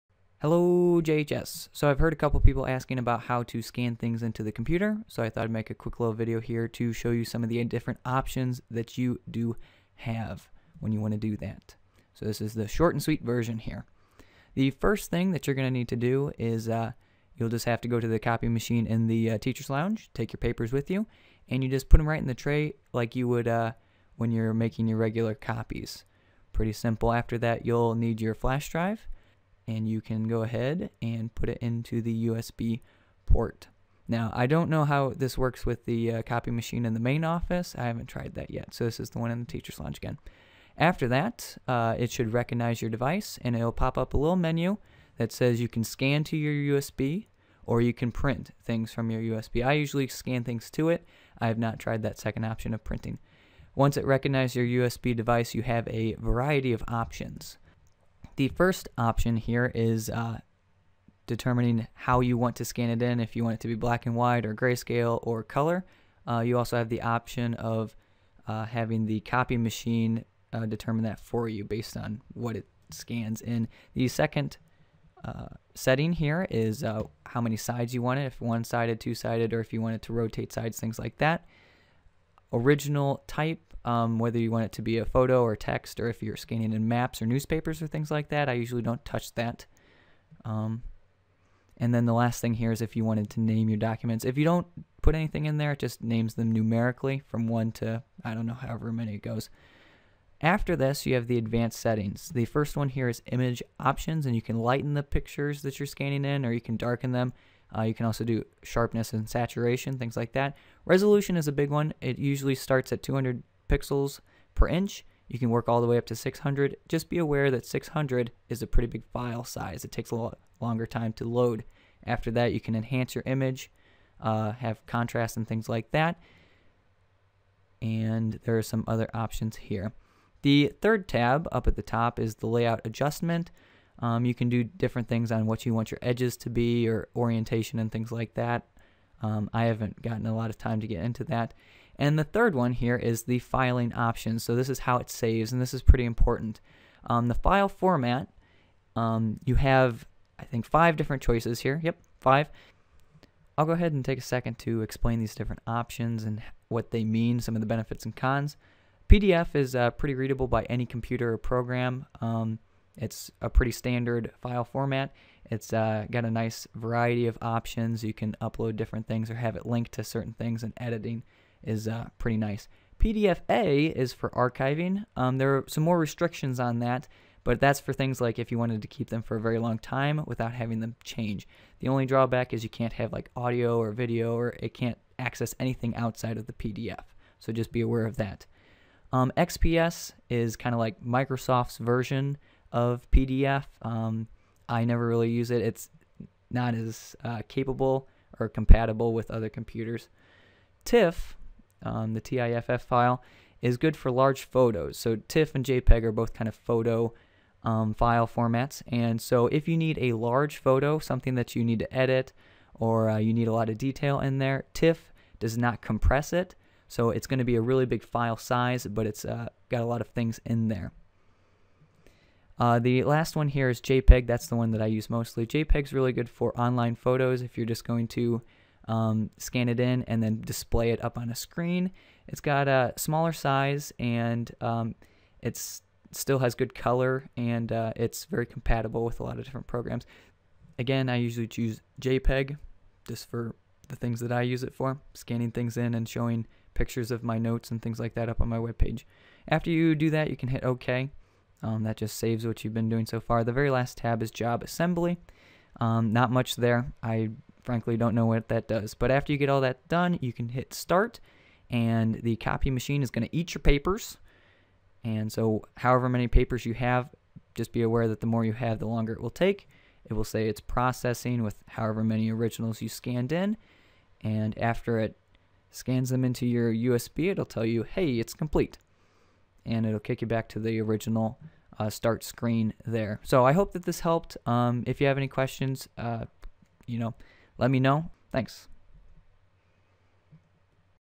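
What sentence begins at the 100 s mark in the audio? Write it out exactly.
After this, you have the advanced settings.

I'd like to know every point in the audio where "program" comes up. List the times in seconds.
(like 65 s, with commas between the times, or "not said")
161 s, 239 s.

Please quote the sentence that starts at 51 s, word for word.
I have not tried that second option of printing.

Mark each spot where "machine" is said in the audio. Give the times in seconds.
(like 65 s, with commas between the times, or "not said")
18 s, 36 s, 69 s, 262 s.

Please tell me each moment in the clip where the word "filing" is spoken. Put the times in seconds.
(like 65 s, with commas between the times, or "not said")
143 s.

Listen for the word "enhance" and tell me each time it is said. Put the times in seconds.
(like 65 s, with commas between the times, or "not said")
122 s.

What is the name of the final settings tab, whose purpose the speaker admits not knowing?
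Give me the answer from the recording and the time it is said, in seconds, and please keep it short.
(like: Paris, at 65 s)
Job assembly, at 254 s.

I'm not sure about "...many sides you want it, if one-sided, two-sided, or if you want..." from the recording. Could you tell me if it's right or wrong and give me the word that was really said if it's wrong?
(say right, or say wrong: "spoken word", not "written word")
right.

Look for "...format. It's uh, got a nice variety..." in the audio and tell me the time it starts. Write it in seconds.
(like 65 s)
164 s.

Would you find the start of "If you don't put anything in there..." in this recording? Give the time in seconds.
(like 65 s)
94 s.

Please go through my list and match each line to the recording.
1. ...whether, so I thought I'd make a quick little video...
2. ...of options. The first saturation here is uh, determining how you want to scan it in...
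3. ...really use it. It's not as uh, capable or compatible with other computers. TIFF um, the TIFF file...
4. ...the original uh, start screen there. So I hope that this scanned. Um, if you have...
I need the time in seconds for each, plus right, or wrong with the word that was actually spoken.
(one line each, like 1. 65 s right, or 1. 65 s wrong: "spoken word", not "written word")
1. 4 s wrong: "computer", not "whether"
2. 56 s wrong: "option", not "saturation"
3. 195 s right
4. 280 s wrong: "helped", not "scanned".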